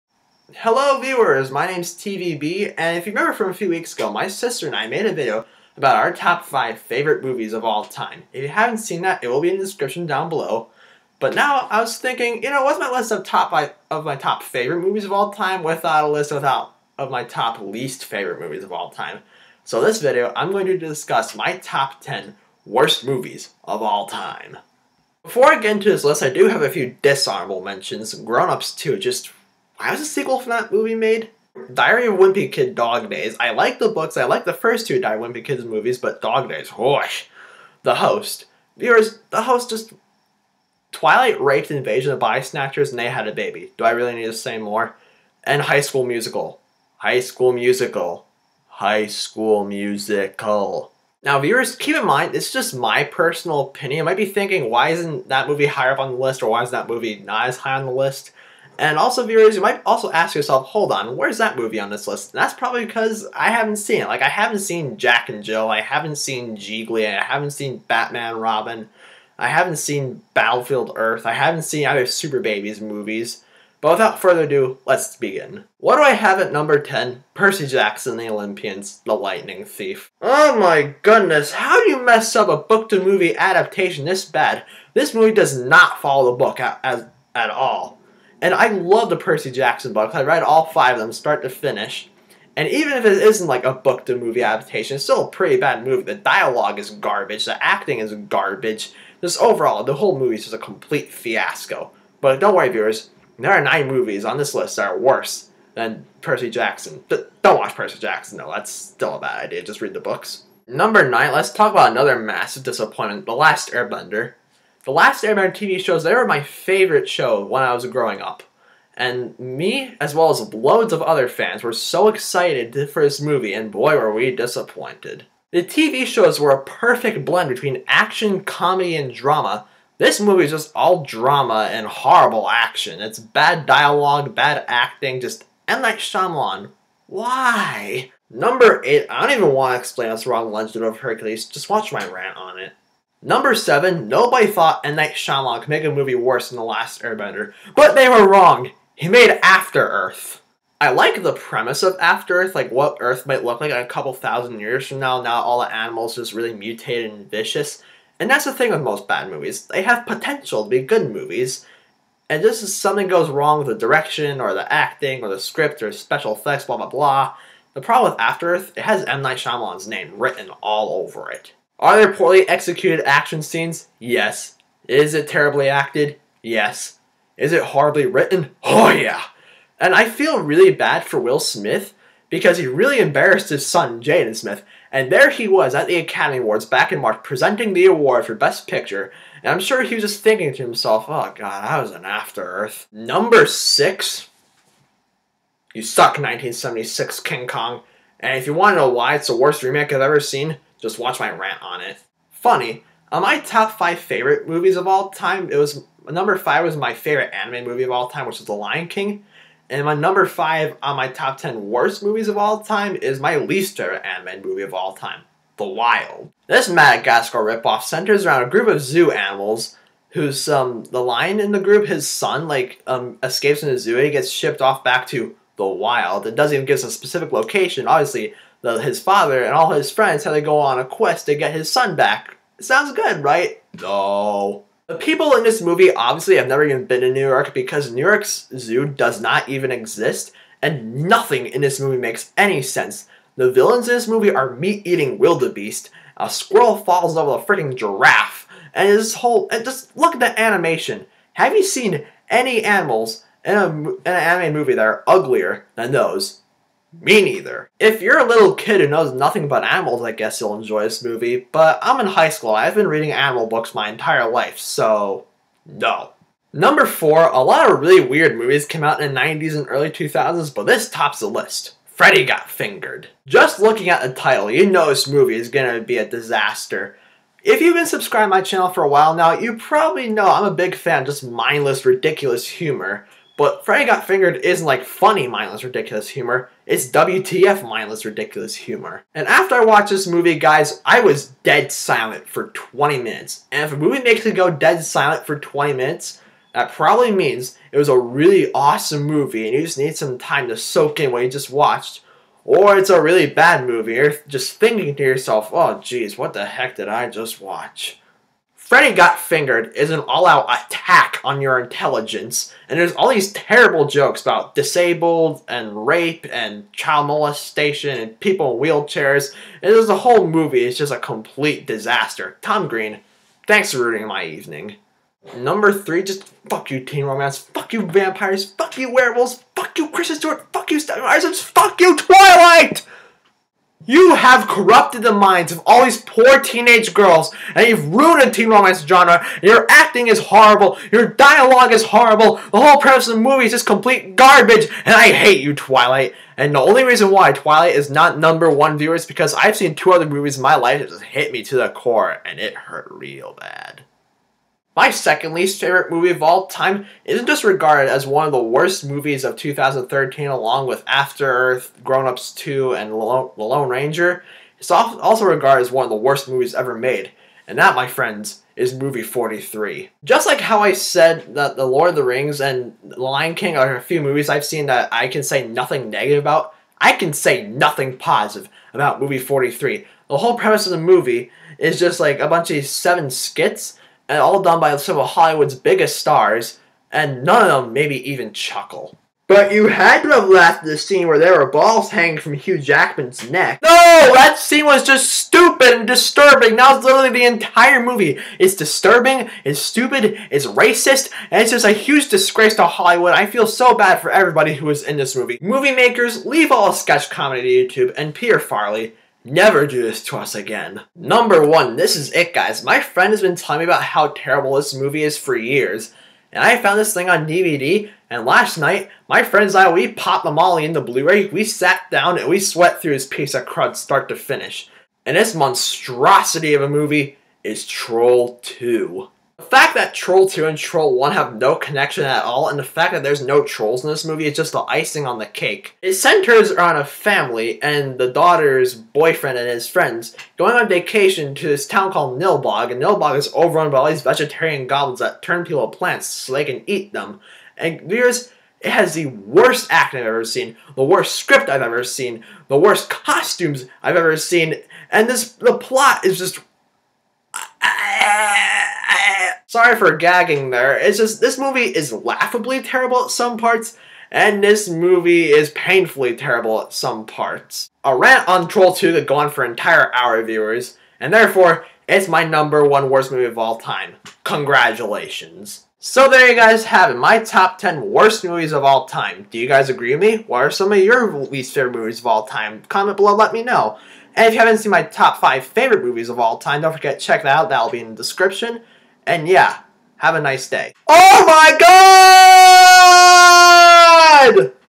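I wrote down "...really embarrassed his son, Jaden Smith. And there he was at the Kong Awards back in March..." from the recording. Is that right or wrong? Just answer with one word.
wrong.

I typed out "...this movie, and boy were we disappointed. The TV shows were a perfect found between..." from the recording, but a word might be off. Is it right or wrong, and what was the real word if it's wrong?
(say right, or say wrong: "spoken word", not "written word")
wrong: "blend", not "found".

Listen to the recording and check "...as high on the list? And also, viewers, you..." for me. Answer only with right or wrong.
right.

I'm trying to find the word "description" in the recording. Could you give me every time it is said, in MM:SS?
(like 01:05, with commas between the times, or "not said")
00:09, 08:07.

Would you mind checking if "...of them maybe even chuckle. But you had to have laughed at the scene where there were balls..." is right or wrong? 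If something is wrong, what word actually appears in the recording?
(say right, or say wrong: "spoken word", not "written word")
right.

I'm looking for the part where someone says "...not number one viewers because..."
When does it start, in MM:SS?
05:47.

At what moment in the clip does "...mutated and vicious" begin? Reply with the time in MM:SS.
02:36.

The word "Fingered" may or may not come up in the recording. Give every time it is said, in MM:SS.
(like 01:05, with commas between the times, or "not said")
04:32, 04:44, 05:09.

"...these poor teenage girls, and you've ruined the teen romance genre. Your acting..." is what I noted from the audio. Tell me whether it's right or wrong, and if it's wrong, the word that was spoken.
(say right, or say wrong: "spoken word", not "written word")
right.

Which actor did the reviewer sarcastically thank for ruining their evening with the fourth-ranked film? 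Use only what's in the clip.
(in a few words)
Tom Green.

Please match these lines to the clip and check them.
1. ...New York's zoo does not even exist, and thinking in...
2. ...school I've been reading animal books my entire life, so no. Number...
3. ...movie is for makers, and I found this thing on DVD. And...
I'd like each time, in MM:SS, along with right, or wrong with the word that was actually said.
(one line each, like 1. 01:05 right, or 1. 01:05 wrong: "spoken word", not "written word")
1. 03:57 wrong: "nothing", not "thinking"
2. 04:22 right
3. 06:54 wrong: "years", not "makers".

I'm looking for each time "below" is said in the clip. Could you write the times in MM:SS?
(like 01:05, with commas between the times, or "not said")
00:10, 08:02.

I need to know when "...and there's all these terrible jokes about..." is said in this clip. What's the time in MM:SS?
05:12.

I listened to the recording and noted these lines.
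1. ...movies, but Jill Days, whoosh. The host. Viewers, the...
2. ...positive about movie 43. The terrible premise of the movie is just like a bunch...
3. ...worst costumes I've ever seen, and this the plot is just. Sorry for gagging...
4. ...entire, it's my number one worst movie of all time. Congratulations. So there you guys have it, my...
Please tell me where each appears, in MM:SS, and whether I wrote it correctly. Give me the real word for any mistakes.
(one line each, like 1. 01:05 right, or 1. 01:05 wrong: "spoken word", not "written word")
1. 00:35 wrong: "Dog", not "Jill"
2. 06:17 wrong: "whole", not "terrible"
3. 07:32 right
4. 07:51 wrong: "therefore", not "entire".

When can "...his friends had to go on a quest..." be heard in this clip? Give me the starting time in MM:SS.
03:49.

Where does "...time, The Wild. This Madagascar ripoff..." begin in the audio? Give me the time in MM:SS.
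03:34.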